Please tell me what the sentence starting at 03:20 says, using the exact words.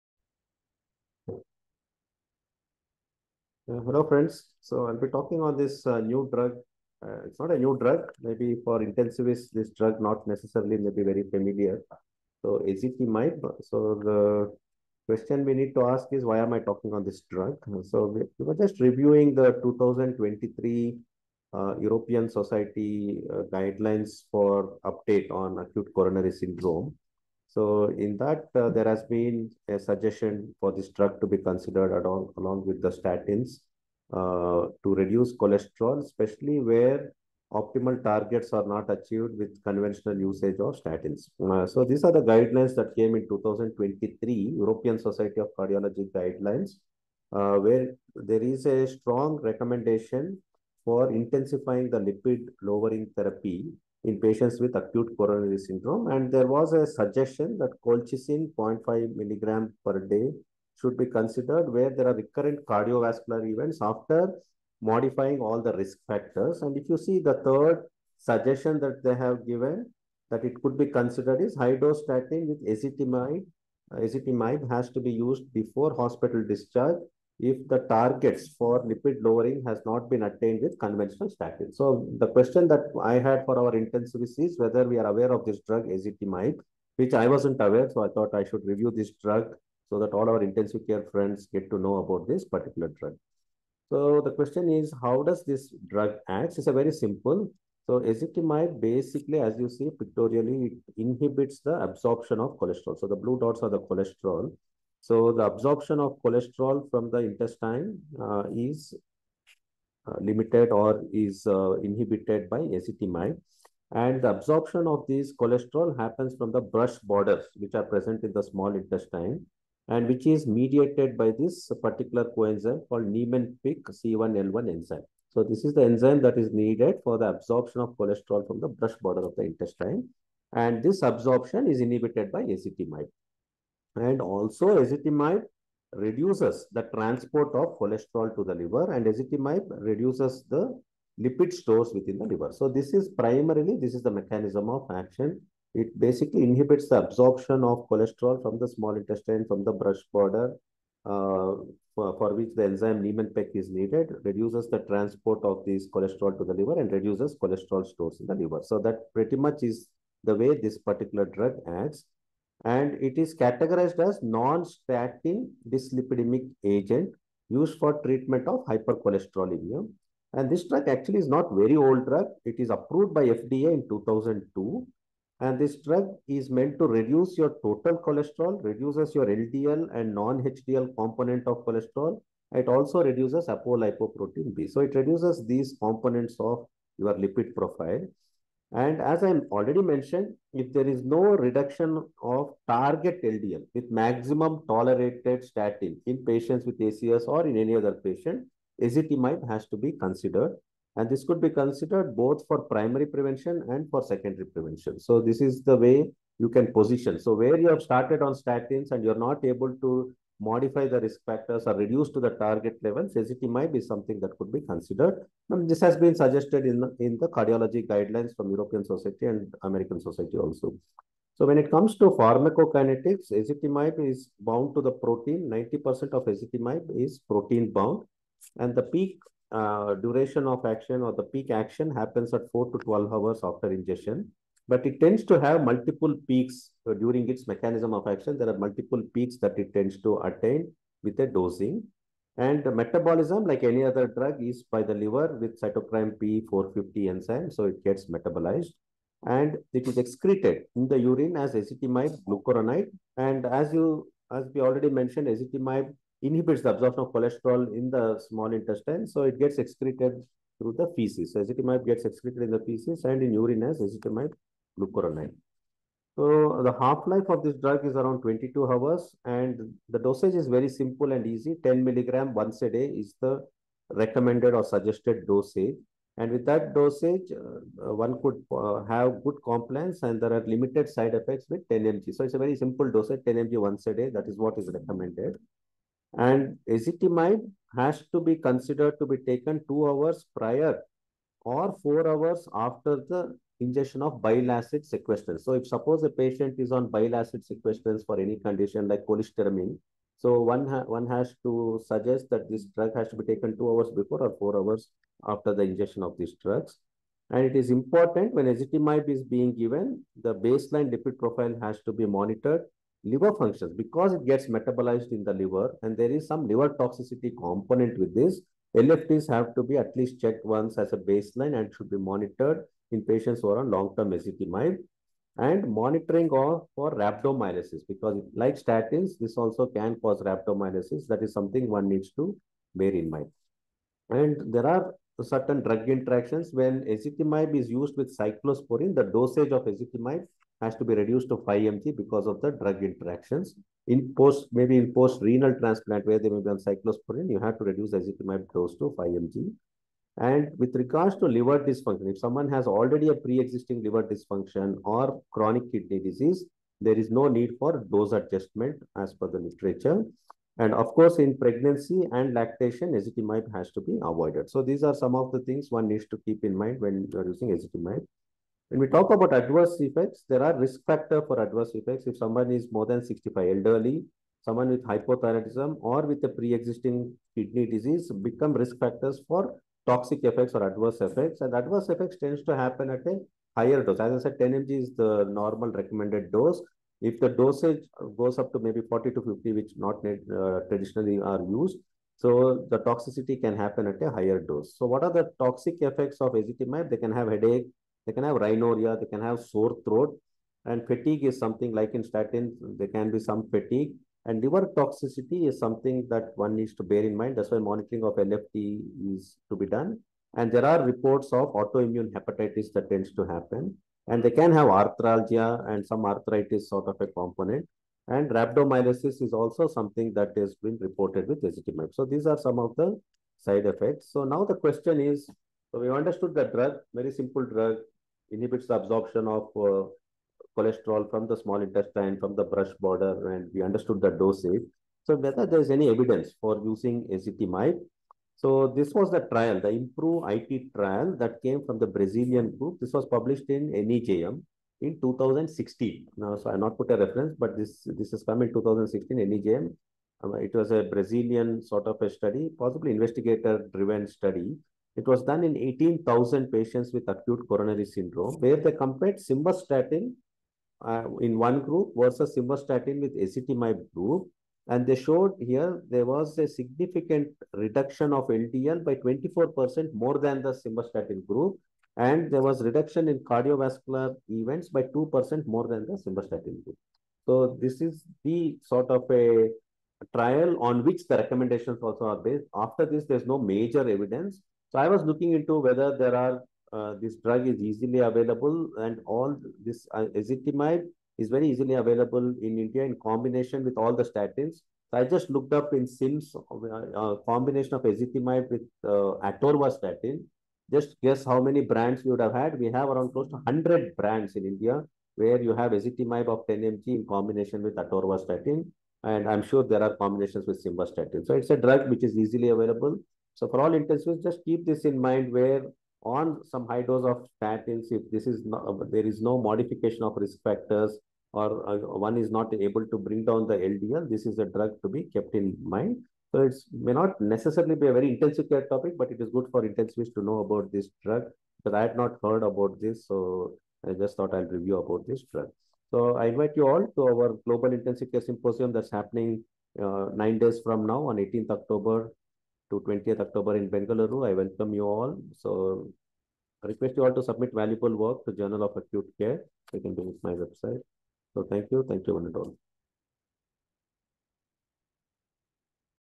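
And this could be considered both for primary prevention and for secondary prevention.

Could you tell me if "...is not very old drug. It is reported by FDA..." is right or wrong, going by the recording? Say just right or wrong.
wrong.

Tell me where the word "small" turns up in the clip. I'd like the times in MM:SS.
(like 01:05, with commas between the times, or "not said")
01:58, 02:28, 04:18, 07:11.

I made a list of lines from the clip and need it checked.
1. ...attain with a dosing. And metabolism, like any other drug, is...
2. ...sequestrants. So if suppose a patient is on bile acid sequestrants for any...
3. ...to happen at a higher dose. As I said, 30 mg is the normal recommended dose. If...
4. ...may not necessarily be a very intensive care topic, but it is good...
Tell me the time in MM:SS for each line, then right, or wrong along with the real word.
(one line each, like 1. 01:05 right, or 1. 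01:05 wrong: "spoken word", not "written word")
1. 04:00 right
2. 04:54 right
3. 06:22 wrong: "10", not "30"
4. 08:46 right.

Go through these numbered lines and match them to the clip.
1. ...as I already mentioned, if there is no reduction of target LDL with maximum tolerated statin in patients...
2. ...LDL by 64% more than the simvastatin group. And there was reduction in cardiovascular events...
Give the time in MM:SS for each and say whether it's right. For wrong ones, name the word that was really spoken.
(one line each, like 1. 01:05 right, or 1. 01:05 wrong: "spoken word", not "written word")
1. 03:09 right
2. 07:48 wrong: "24", not "64".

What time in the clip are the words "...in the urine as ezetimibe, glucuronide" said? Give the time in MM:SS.
04:10.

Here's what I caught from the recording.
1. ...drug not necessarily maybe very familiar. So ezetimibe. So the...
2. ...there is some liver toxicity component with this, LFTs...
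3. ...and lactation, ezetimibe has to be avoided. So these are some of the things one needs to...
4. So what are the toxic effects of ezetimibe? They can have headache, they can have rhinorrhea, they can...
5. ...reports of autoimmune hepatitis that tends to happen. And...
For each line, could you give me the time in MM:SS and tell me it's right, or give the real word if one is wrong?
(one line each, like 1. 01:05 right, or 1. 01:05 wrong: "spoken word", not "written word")
1. 00:09 right
2. 05:15 right
3. 06:02 right
4. 06:34 right
5. 06:50 right.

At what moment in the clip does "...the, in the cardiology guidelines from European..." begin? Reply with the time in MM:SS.
03:36.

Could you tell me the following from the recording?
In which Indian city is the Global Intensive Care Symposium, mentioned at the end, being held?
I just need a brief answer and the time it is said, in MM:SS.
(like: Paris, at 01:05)
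Bengaluru, at 09:03.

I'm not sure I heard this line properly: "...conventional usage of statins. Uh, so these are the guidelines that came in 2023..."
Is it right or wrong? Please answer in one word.
right.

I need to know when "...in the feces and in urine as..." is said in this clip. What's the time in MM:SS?
04:22.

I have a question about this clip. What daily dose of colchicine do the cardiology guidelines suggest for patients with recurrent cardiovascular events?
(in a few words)
0.5 milligram.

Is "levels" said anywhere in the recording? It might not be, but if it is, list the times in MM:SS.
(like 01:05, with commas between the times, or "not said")
03:32.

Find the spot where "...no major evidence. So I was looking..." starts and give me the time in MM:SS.
08:03.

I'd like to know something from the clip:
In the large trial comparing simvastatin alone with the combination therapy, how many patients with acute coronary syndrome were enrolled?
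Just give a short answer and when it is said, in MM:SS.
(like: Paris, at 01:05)
18,000, at 07:35.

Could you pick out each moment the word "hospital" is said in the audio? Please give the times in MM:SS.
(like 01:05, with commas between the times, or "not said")
01:15.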